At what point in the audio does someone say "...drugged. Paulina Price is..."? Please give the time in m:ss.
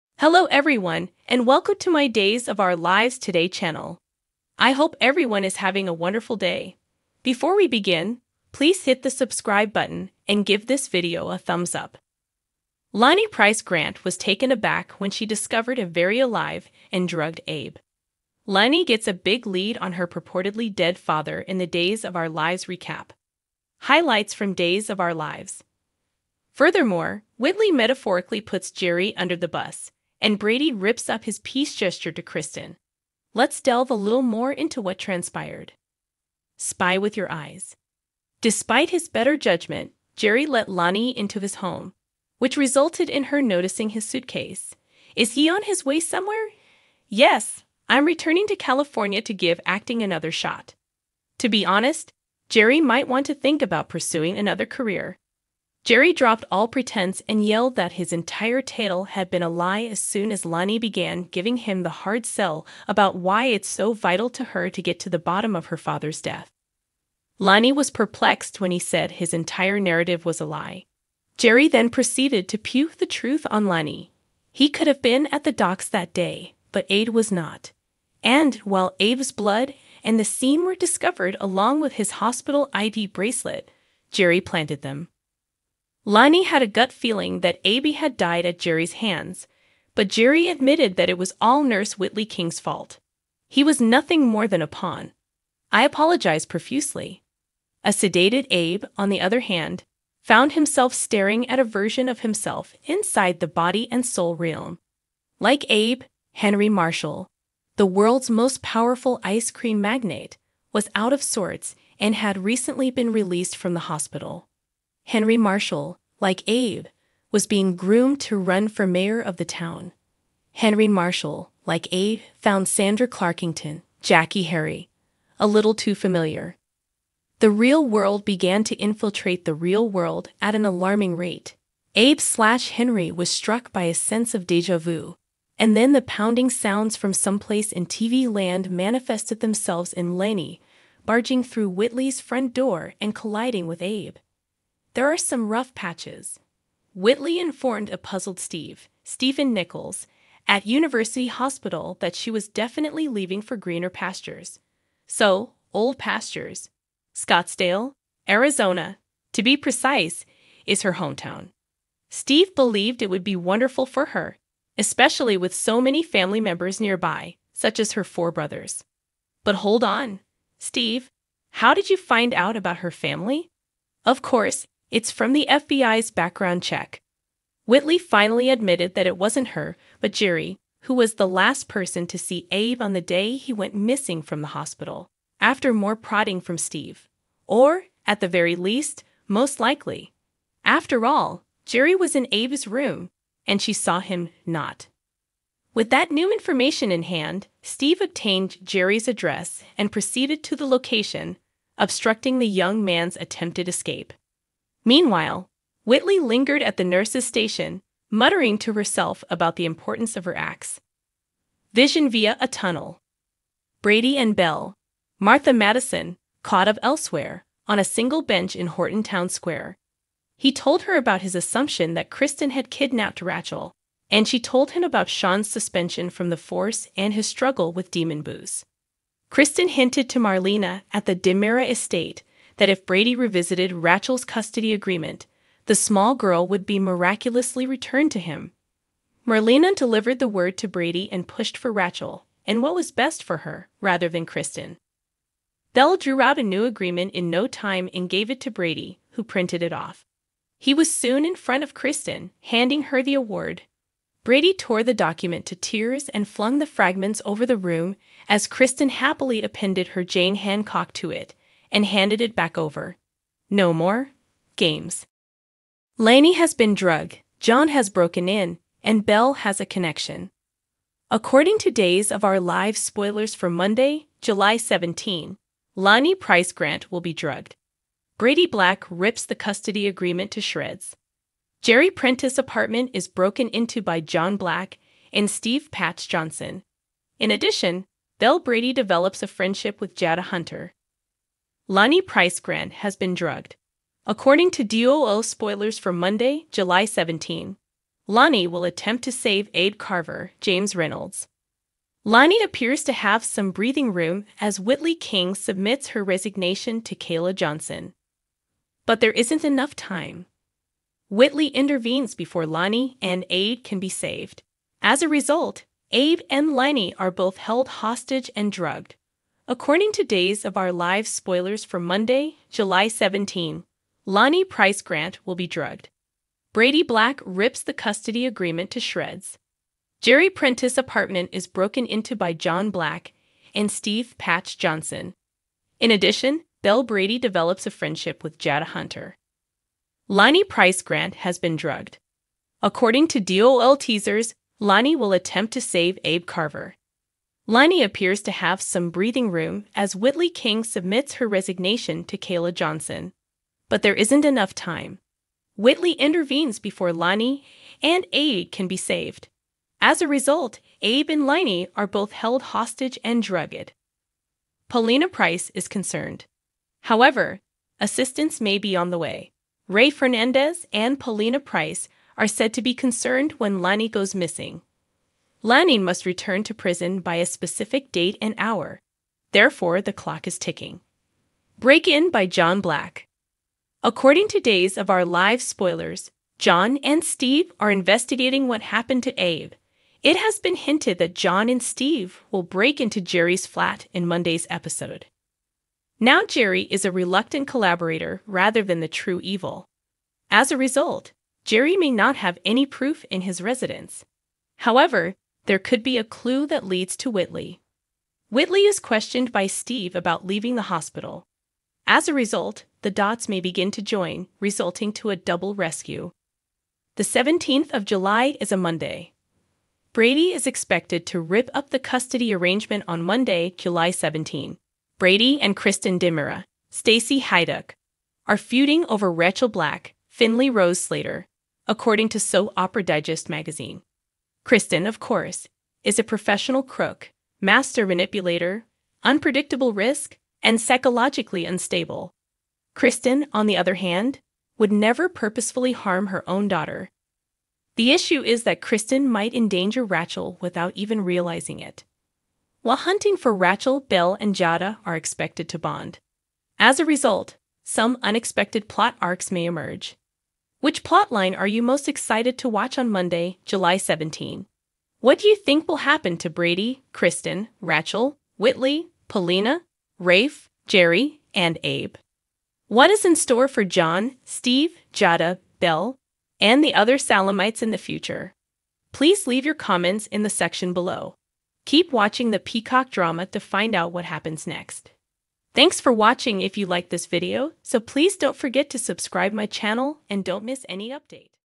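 6:03.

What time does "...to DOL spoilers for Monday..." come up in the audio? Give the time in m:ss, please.
4:54.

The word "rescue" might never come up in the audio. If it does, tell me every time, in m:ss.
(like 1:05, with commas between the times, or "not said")
6:55.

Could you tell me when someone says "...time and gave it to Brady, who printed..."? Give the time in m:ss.
4:07.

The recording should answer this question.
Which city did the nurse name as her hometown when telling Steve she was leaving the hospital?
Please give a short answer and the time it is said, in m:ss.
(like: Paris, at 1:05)
Scottsdale, Arizona, at 2:37.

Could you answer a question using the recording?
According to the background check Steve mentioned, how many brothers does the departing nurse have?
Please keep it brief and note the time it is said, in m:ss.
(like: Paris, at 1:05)
4, at 2:48.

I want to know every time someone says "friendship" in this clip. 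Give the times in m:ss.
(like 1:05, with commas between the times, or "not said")
4:49, 5:37.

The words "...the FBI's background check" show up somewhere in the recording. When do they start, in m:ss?
2:55.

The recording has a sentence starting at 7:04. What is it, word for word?
Brady and Kristen DiMera, Stacy Haiduk, are feuding over Rachel Black, Finley Rose Slater, according to Soap Opera Digest magazine.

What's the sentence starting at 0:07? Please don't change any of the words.
Before we begin, please hit the subscribe button and give this video a thumbs up.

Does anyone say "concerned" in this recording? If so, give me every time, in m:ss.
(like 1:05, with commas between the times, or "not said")
6:05, 6:12.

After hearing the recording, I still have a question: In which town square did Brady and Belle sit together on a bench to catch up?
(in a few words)
Horton Town Square.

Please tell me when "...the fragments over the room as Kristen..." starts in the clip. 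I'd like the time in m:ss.
4:16.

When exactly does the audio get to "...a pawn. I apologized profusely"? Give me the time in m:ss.
1:34.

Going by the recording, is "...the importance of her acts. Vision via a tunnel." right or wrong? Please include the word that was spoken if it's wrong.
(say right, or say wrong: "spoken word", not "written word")
right.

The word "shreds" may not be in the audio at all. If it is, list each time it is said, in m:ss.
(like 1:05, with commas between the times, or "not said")
4:40, 5:28.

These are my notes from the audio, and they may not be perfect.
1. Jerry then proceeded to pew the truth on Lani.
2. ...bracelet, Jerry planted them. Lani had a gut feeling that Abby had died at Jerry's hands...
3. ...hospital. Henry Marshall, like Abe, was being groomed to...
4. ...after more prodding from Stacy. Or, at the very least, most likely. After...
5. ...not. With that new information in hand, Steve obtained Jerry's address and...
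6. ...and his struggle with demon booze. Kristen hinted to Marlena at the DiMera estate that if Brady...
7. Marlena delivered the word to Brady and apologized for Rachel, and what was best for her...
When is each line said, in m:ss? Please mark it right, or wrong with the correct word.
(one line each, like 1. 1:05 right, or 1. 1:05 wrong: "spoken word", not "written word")
1. 1:11 right
2. 1:23 right
3. 1:53 right
4. 3:05 wrong: "Steve", not "Stacy"
5. 3:14 right
6. 3:46 right
7. 3:59 wrong: "pushed", not "apologized".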